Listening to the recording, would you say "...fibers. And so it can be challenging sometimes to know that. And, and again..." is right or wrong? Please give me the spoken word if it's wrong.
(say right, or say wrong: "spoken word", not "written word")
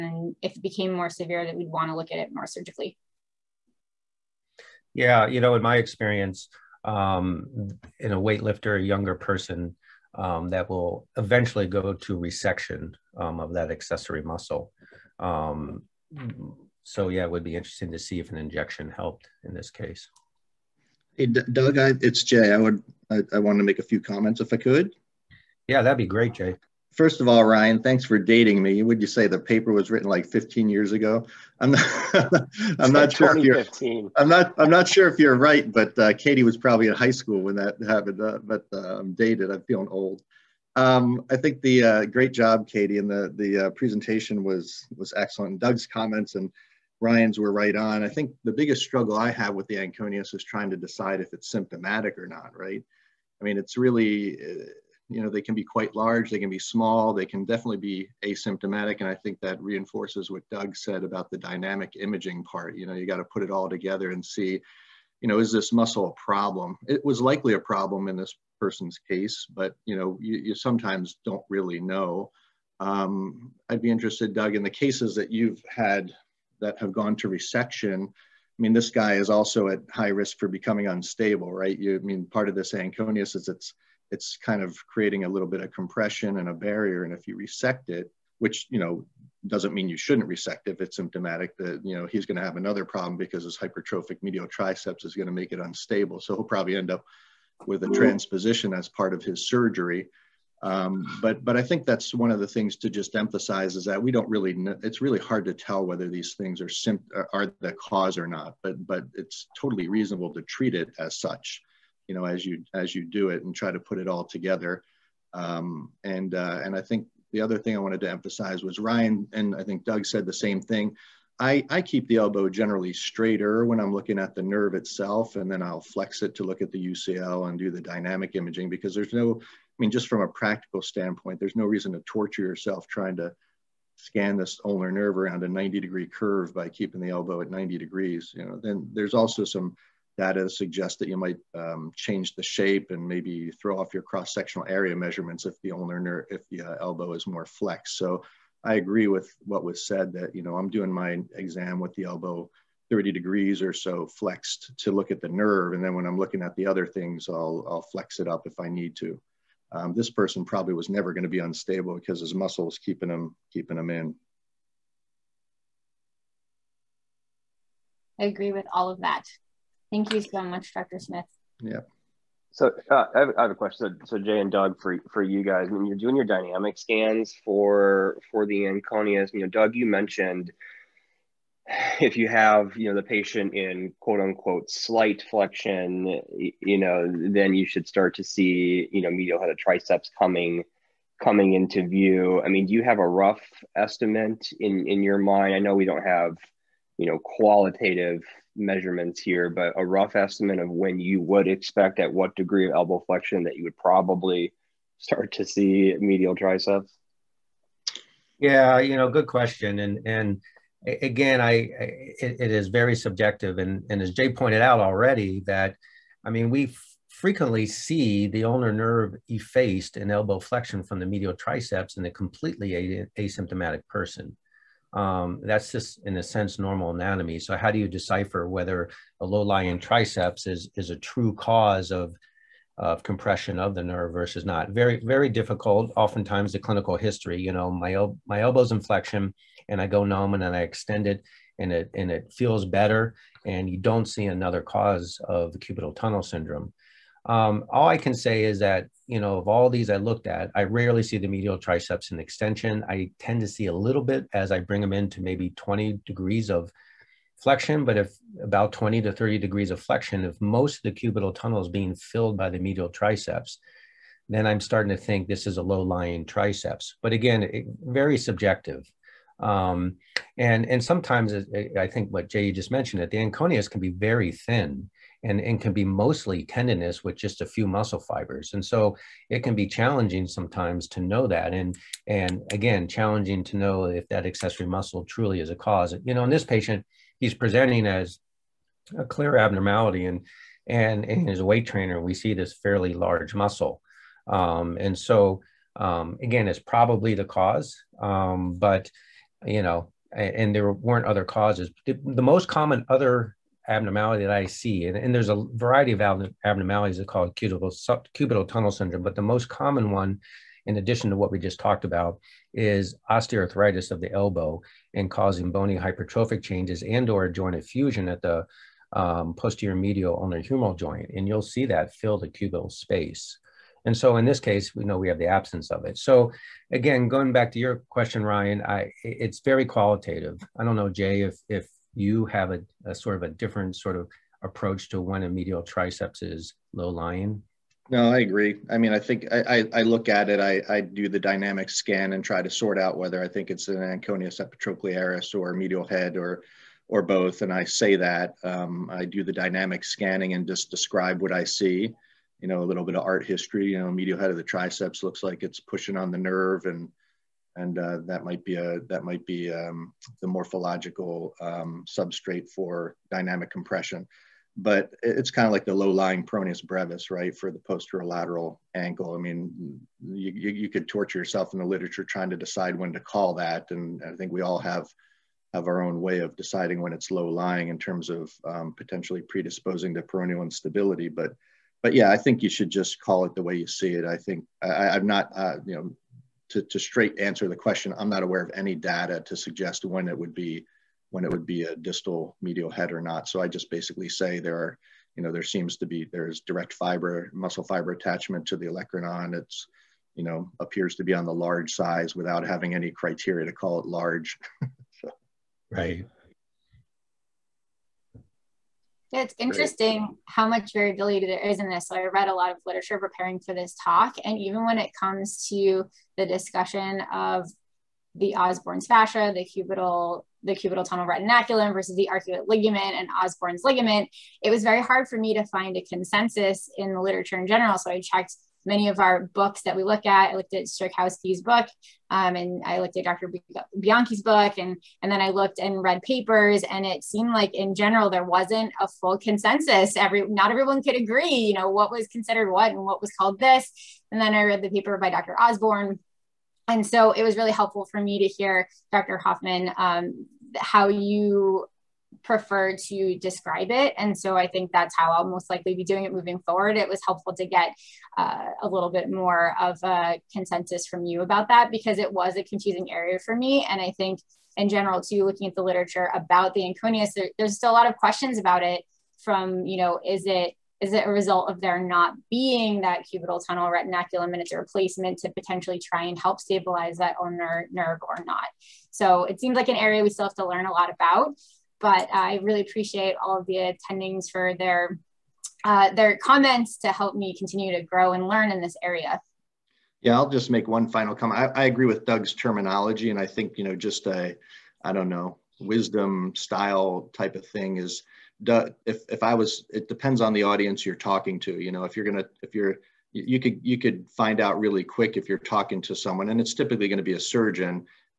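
right.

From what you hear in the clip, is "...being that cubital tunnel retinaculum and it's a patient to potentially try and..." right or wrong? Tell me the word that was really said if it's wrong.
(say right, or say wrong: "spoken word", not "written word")
wrong: "replacement", not "patient".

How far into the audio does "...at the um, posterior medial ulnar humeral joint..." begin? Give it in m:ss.
5:18.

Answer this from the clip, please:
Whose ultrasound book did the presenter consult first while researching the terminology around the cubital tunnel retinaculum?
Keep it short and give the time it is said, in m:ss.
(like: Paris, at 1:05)
Strakowski, at 7:10.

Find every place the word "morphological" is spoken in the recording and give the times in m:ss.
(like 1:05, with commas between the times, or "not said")
6:00.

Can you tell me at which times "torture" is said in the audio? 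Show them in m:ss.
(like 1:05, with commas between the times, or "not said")
2:12, 6:10.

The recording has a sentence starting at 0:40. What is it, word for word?
Um, I think the uh, great job, Katie, and the, the uh, presentation was, was excellent.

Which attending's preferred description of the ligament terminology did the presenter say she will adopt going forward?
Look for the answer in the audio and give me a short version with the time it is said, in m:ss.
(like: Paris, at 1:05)
Dr. Hoffman, at 7:28.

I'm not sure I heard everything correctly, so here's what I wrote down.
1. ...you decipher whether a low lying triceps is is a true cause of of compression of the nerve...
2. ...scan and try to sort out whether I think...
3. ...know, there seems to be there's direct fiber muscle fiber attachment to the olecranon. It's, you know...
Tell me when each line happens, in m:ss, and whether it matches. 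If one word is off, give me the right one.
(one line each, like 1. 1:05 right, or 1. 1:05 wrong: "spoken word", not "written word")
1. 3:47 right
2. 5:41 right
3. 6:35 right.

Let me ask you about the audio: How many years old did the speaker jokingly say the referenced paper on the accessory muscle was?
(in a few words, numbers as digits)
15.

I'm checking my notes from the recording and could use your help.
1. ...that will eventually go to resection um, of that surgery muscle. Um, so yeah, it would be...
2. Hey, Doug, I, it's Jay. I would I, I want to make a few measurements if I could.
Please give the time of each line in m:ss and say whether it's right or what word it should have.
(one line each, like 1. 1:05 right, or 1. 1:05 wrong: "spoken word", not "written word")
1. 0:10 wrong: "accessory", not "surgery"
2. 0:21 wrong: "comments", not "measurements".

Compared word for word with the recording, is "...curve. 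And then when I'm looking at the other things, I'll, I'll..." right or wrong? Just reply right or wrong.
wrong.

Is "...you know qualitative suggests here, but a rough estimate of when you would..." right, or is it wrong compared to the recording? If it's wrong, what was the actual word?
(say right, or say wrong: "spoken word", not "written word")
wrong: "measurements", not "suggests".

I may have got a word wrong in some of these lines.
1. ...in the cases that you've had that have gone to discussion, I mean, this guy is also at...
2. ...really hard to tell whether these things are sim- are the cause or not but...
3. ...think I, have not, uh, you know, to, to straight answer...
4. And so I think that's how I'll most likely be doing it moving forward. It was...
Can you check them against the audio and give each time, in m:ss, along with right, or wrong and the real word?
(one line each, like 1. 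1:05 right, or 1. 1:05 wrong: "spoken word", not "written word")
1. 1:14 wrong: "resection", not "discussion"
2. 1:45 right
3. 6:24 right
4. 7:33 right.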